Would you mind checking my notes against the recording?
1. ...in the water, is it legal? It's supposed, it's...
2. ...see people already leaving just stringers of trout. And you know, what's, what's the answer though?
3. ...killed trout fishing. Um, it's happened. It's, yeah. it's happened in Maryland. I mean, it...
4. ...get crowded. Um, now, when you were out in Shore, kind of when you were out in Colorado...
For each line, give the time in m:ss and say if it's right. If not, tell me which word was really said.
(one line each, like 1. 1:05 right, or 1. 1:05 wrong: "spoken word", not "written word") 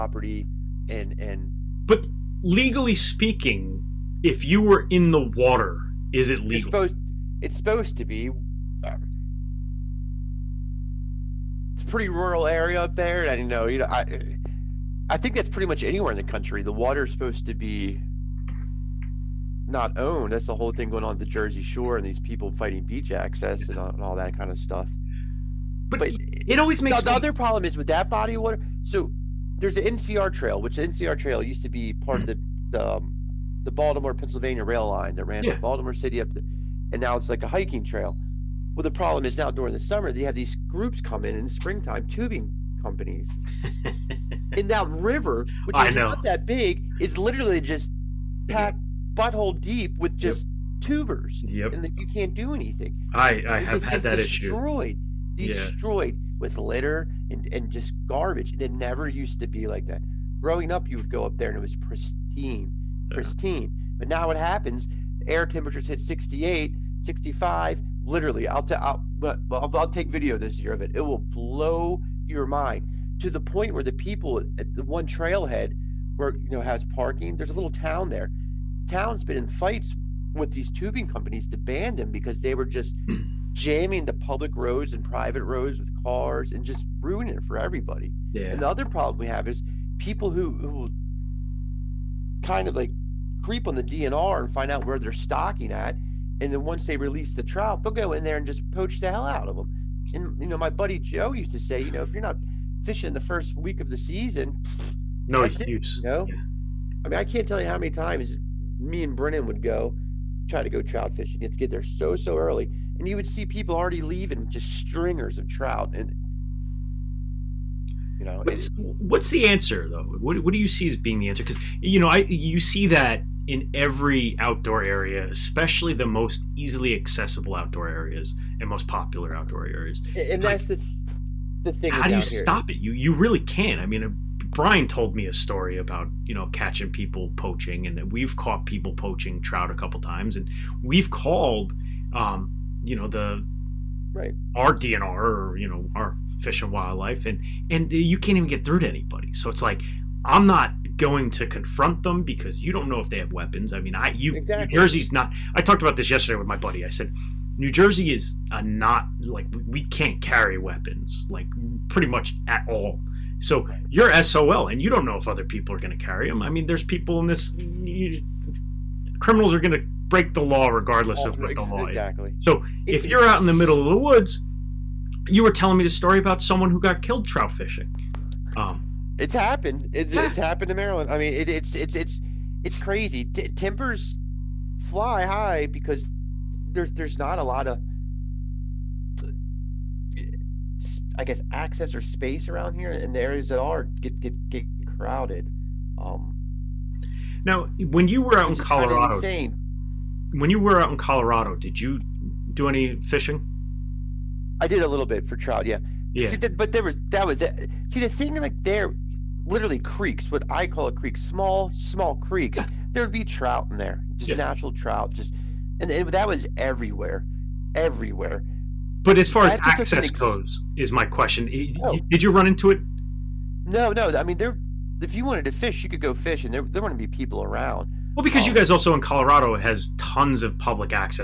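1. 0:04 right
2. 1:53 right
3. 2:57 right
4. 3:14 wrong: "Colorado", not "Shore".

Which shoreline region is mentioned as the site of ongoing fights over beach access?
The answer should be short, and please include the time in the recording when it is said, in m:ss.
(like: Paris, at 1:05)
Jersey Shore, at 0:21.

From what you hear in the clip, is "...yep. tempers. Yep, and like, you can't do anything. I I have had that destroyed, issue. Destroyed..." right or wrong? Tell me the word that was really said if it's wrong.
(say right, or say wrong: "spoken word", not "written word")
wrong: "tubers", not "tempers".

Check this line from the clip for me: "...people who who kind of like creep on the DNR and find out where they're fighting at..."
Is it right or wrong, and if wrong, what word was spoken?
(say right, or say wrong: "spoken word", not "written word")
wrong: "stocking", not "fighting".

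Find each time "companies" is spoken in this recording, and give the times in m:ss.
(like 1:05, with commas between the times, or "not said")
0:42, 1:21.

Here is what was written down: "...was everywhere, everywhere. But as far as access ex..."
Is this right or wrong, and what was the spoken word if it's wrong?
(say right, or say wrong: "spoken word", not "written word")
right.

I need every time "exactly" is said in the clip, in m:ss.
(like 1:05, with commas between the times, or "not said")
2:34, 2:51.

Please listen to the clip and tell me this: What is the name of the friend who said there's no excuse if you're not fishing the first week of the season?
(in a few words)
Joe.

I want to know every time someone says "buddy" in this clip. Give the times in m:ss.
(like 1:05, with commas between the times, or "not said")
1:40, 2:36.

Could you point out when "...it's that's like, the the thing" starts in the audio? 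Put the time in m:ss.
2:10.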